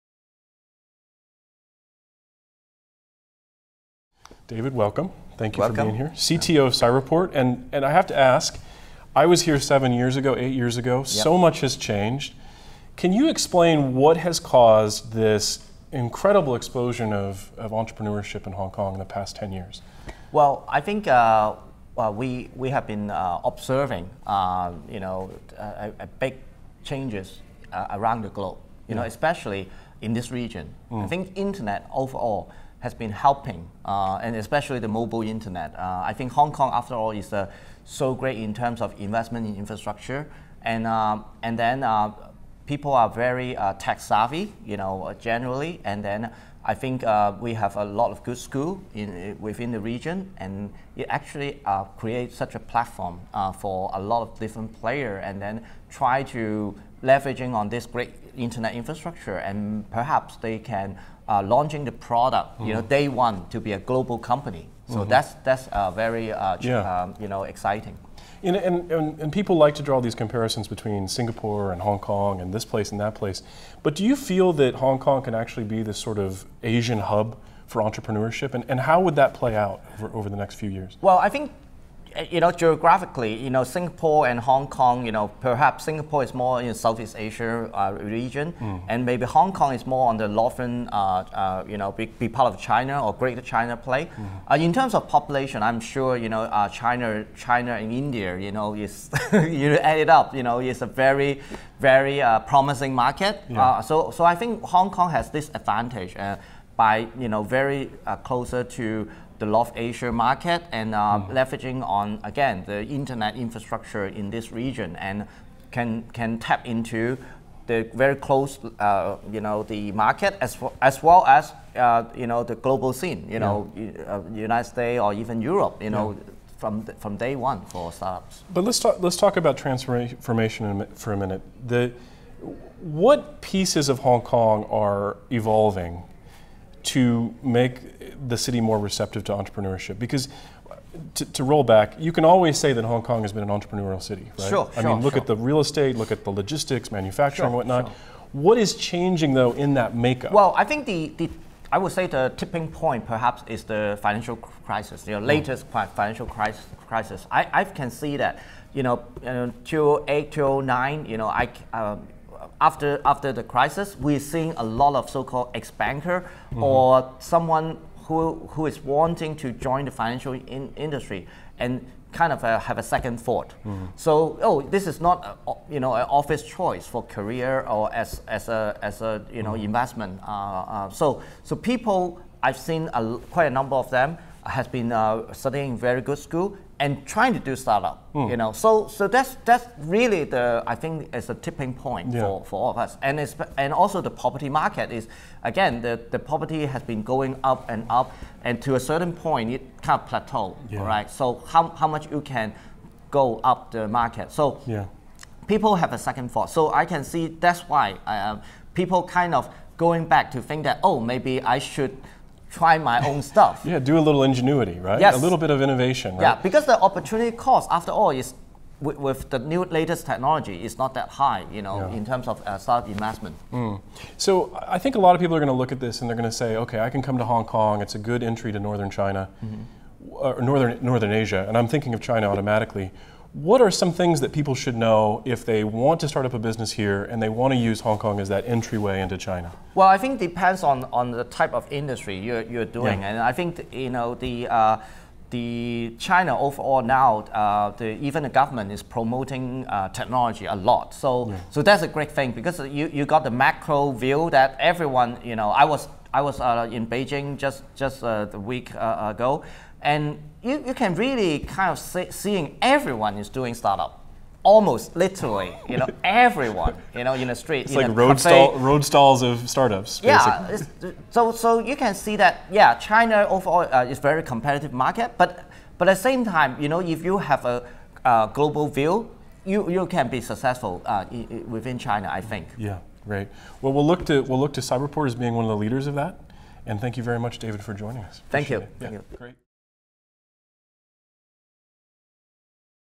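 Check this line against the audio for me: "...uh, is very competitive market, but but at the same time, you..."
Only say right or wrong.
right.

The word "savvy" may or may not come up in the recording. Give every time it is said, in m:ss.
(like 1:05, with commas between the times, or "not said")
0:43.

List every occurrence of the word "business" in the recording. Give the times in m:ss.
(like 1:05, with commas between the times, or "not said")
3:56.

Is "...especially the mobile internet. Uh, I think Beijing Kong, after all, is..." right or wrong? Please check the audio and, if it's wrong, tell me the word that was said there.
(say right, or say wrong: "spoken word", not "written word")
wrong: "Hong", not "Beijing".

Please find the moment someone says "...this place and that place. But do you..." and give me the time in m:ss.
1:12.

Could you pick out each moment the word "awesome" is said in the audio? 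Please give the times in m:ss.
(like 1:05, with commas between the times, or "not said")
not said.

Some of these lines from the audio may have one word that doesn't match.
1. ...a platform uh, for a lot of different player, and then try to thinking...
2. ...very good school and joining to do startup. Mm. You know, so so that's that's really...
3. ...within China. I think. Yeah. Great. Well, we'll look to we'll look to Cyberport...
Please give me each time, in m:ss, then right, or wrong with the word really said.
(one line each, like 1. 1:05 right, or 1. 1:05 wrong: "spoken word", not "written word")
1. 0:52 wrong: "leveraging", not "thinking"
2. 3:05 wrong: "trying", not "joining"
3. 4:41 right.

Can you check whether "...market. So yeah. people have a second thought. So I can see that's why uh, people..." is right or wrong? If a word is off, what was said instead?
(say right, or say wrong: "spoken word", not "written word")
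right.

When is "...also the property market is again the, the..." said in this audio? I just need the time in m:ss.
3:13.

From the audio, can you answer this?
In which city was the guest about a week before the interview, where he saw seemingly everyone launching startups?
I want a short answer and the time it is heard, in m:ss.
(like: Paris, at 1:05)
Beijing, at 4:16.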